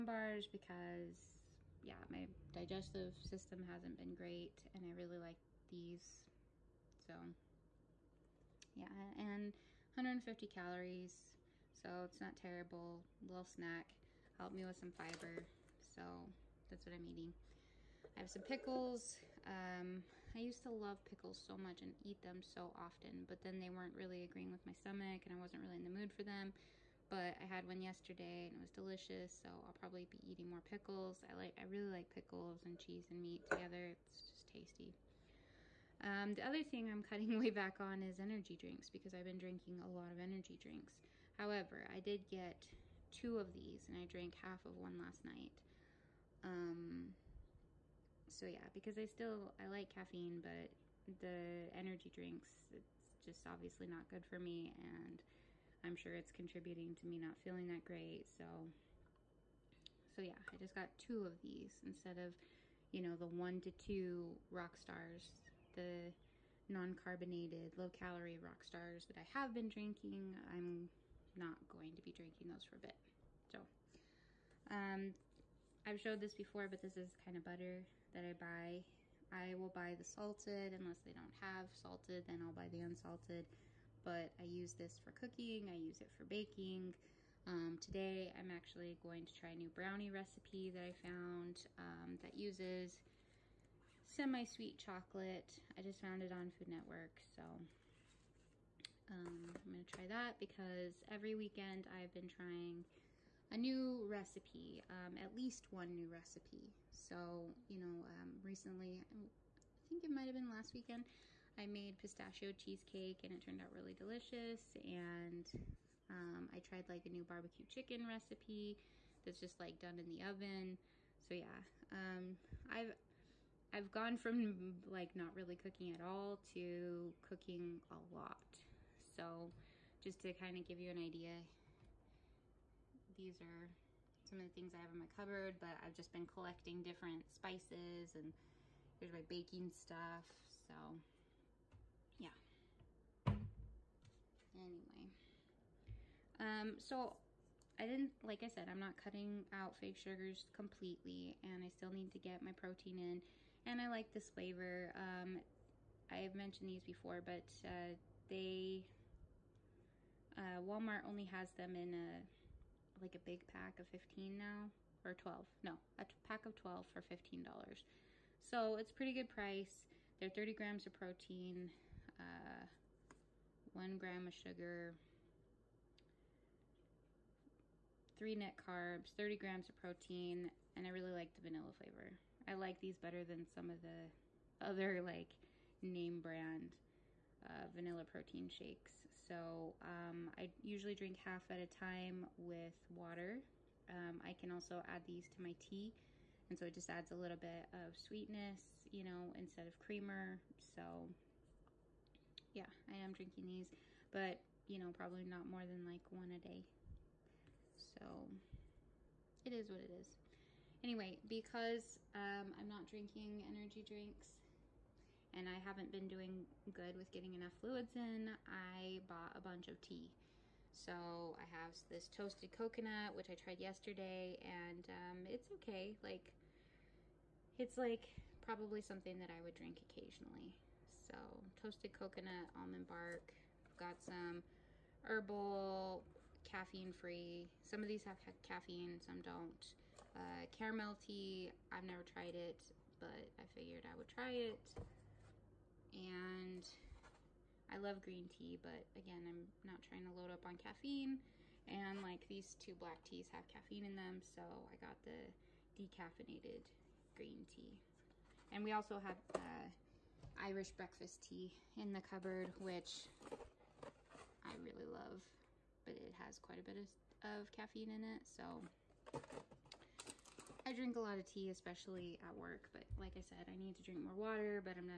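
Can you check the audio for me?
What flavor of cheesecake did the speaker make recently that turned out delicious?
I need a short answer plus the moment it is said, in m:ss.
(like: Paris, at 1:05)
pistachio, at 1:51.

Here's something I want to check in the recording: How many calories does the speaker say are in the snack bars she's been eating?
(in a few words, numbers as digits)
150.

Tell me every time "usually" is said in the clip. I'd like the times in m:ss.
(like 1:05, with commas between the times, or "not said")
3:10.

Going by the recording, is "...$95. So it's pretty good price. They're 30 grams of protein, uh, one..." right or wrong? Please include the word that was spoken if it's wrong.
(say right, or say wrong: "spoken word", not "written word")
wrong: "15", not "95".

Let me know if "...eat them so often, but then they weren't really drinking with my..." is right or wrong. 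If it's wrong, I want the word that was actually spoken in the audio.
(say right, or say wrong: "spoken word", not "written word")
wrong: "agreeing", not "drinking".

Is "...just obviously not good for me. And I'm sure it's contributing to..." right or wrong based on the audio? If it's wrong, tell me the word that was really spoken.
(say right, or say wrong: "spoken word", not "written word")
right.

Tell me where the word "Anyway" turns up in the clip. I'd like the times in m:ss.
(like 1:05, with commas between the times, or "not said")
2:24, 3:30.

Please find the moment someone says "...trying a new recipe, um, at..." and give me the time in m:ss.
1:42.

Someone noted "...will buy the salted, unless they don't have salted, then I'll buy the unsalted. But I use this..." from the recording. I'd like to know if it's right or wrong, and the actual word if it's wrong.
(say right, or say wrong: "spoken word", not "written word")
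right.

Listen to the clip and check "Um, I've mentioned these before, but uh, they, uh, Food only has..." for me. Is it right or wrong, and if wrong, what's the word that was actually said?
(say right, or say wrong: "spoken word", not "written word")
wrong: "Walmart", not "Food".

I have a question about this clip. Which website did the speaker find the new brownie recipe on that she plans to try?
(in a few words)
Food Network.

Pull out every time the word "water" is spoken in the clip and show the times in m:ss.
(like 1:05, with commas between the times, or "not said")
3:12, 4:34.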